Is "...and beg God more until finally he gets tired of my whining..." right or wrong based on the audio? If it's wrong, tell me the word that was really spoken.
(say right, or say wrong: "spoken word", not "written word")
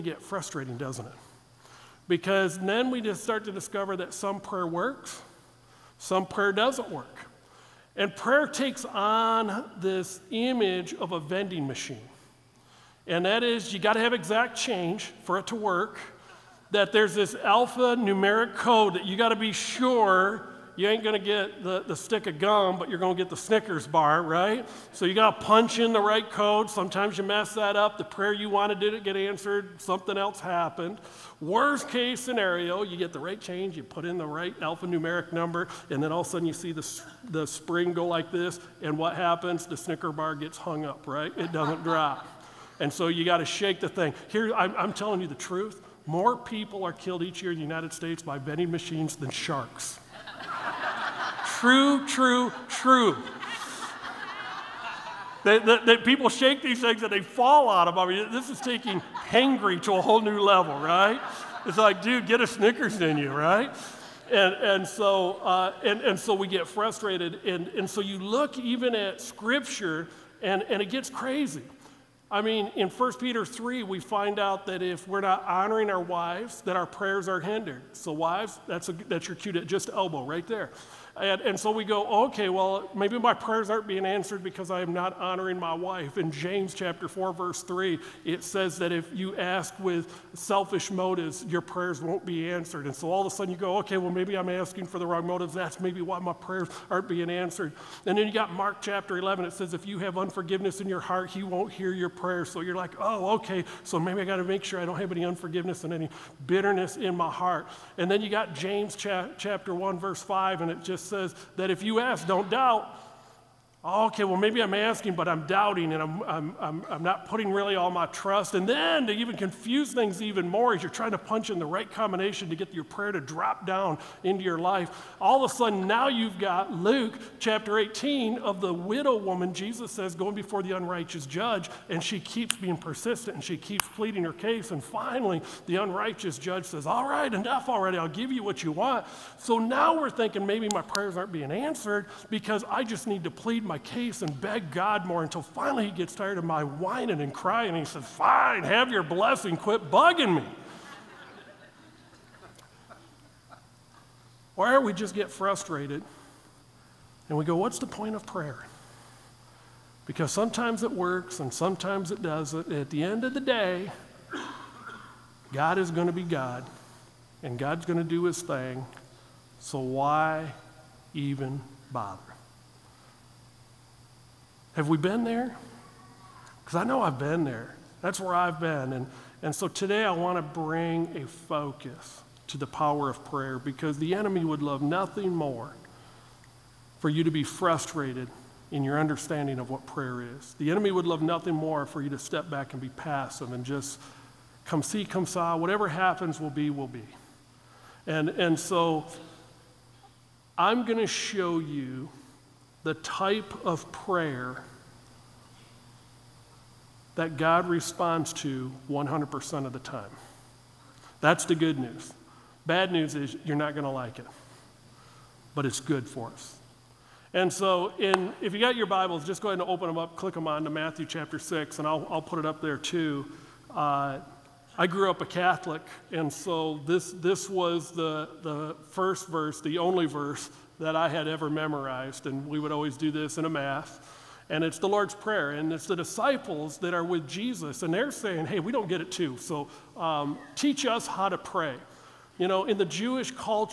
right.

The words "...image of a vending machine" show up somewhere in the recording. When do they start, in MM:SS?
00:10.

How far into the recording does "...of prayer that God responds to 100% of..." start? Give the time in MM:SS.
03:23.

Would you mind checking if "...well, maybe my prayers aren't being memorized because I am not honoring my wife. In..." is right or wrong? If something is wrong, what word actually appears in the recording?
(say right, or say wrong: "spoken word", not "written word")
wrong: "answered", not "memorized".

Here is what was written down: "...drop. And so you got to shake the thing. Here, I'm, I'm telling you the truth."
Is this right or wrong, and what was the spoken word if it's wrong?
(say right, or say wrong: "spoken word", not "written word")
right.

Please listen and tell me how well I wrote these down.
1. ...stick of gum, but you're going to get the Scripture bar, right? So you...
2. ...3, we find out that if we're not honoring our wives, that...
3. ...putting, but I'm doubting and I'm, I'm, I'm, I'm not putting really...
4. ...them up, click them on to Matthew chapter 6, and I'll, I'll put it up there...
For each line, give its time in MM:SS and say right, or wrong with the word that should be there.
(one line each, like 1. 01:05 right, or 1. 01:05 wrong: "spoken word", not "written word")
1. 00:21 wrong: "Snickers", not "Scripture"
2. 01:13 right
3. 01:54 wrong: "asking", not "putting"
4. 03:39 right.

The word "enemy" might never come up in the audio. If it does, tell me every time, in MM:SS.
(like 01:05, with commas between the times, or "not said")
03:04, 03:10.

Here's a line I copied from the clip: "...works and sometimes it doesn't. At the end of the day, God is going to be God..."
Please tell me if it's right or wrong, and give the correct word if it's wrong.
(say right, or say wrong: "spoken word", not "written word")
right.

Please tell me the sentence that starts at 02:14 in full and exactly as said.
And finally, the unrighteous judge says, All right, enough already, I'll give you what you want.